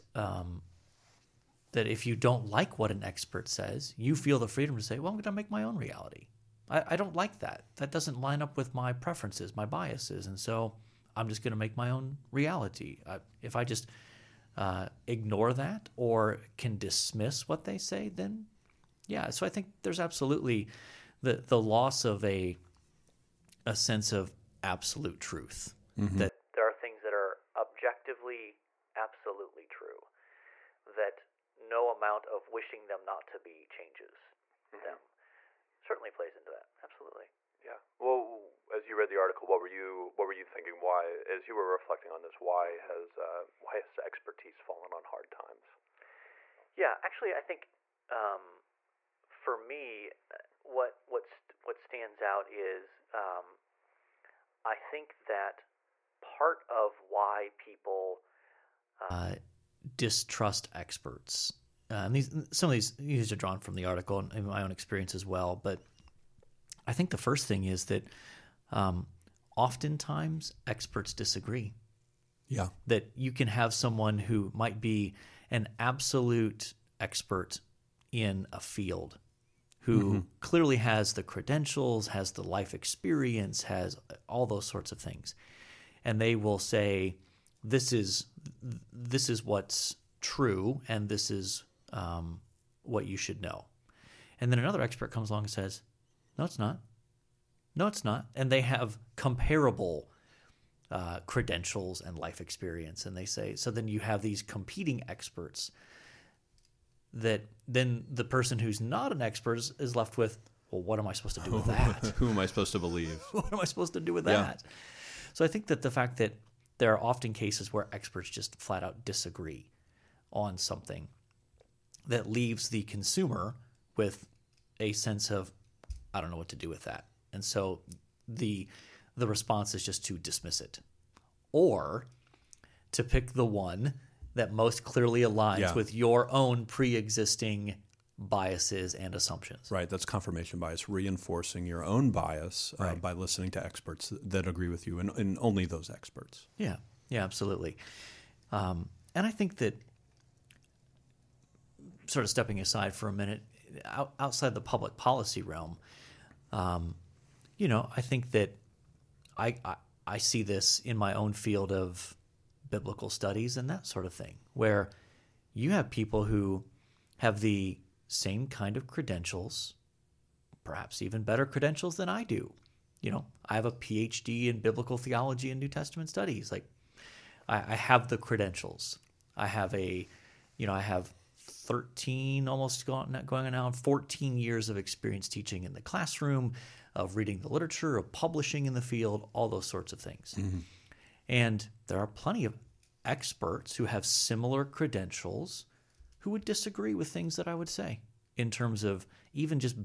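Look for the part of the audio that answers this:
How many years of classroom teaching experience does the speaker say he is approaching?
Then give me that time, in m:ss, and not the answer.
3:03.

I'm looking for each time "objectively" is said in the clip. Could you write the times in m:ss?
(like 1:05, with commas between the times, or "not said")
0:27.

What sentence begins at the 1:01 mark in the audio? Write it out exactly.
Uh, and these some of these these are drawn from the article and my own experience as well.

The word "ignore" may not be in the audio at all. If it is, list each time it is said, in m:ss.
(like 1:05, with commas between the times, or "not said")
0:15.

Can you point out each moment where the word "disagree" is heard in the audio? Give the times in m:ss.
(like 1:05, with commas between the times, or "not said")
1:11, 1:59, 3:16.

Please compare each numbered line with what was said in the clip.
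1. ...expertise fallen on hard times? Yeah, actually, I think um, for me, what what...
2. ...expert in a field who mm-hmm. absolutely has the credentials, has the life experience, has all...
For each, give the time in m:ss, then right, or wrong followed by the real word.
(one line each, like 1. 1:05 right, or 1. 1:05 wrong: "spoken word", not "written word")
1. 0:43 right
2. 1:16 wrong: "clearly", not "absolutely".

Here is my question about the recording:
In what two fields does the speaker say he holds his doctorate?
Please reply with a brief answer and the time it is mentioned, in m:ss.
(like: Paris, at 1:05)
Biblical theology and New Testament studies, at 2:54.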